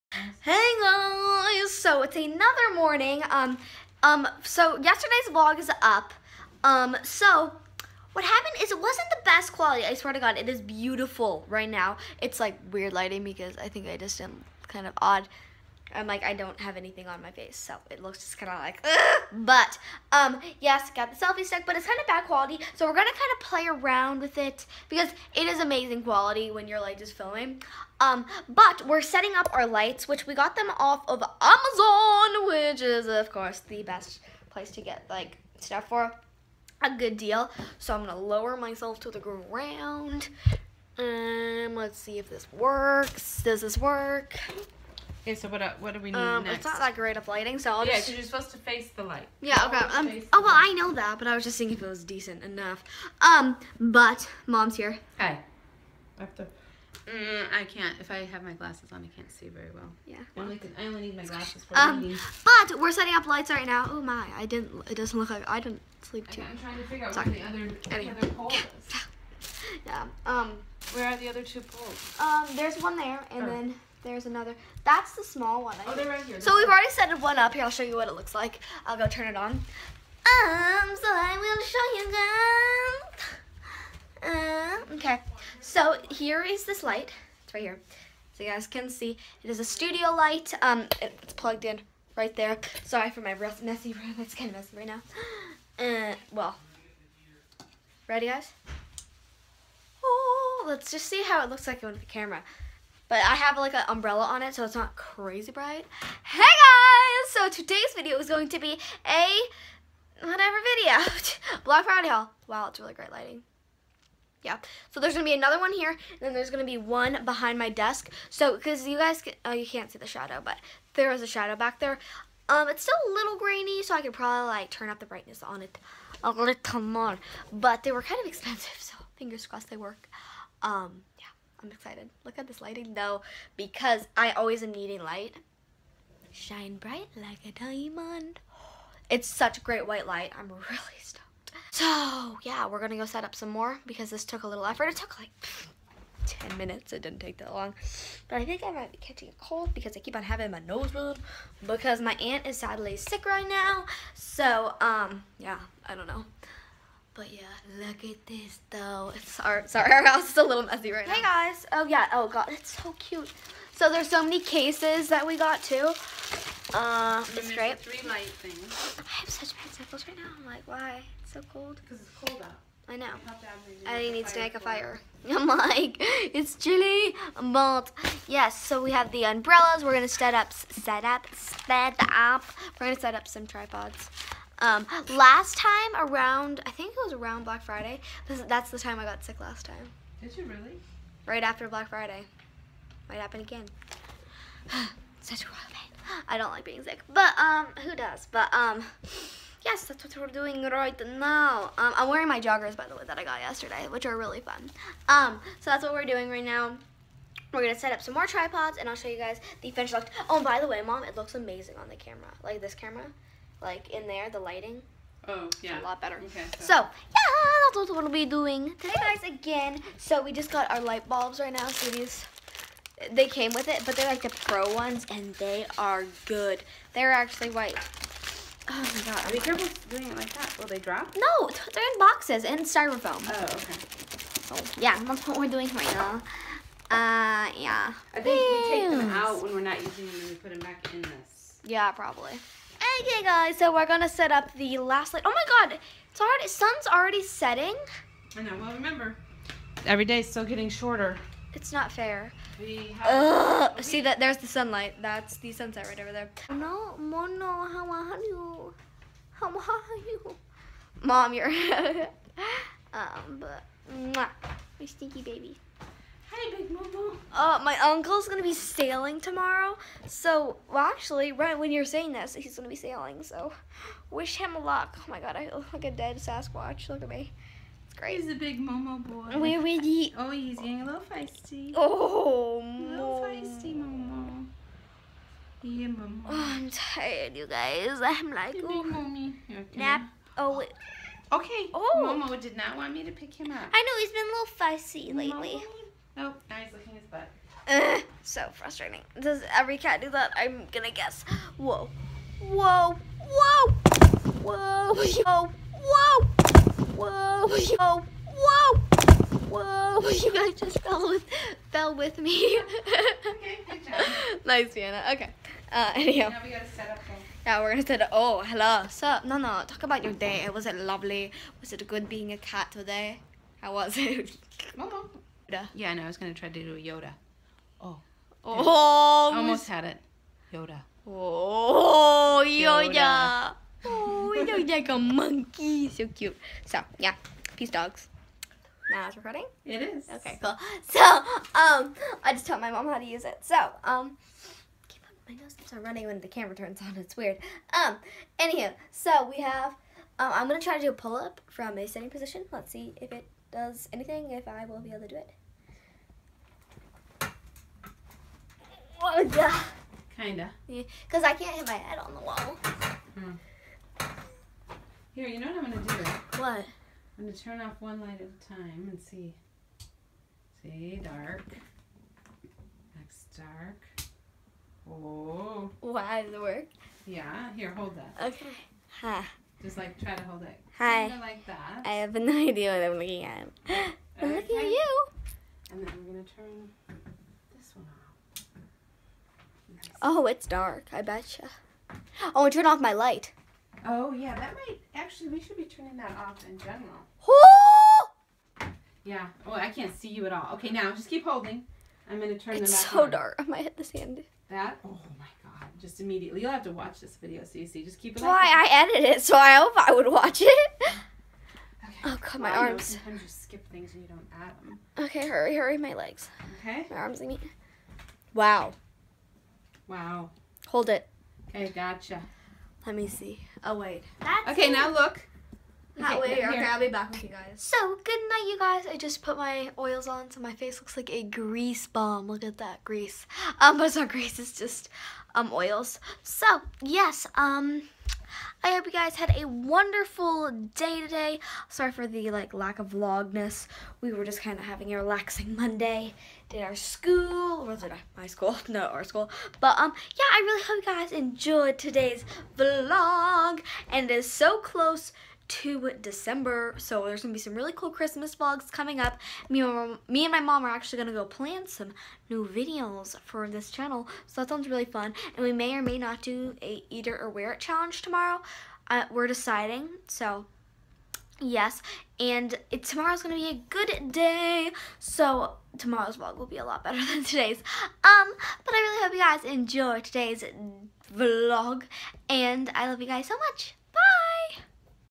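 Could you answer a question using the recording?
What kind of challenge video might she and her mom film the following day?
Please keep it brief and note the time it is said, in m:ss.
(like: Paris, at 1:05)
either or wear it challenge, at 7:46.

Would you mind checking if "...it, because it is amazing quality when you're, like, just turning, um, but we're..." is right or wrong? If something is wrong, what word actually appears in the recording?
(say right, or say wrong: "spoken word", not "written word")
wrong: "filming", not "turning".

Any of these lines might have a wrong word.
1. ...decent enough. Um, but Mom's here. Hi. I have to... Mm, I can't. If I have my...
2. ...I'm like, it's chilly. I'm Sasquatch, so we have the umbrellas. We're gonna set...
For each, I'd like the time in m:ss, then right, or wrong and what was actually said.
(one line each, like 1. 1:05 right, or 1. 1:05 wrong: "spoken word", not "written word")
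1. 0:52 right
2. 2:55 wrong: "Yes", not "Sasquatch".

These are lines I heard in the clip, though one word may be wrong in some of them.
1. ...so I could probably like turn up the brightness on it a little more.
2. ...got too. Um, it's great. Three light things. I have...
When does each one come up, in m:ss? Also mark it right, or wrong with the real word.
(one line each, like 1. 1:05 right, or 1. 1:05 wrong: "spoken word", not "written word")
1. 2:03 right
2. 2:45 right.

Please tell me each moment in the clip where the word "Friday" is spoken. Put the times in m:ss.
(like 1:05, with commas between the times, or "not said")
1:51, 3:07, 3:11.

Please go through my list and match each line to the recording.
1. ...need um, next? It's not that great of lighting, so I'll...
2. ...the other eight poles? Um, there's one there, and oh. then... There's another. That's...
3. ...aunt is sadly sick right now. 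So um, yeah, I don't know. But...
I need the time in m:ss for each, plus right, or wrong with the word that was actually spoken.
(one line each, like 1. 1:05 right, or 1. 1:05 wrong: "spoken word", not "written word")
1. 0:46 right
2. 1:11 wrong: "two", not "eight"
3. 2:32 right.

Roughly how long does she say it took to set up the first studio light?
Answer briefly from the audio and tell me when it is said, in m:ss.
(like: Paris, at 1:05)
10 minutes, at 2:26.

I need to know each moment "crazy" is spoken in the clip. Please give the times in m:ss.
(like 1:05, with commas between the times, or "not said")
1:44, 4:37.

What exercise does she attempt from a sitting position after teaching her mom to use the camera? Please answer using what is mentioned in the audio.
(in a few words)
pull-up.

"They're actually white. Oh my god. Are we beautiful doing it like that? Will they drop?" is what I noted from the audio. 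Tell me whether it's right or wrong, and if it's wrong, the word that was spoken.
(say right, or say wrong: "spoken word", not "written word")
wrong: "careful", not "beautiful".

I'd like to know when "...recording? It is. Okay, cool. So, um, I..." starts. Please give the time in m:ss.
5:39.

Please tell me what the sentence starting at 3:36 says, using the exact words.
So, so yeah, that's what we'll be doing today, guys, again.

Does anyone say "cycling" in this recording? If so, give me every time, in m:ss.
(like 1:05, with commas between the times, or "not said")
not said.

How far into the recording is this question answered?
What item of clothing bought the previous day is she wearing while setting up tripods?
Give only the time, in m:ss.
3:22.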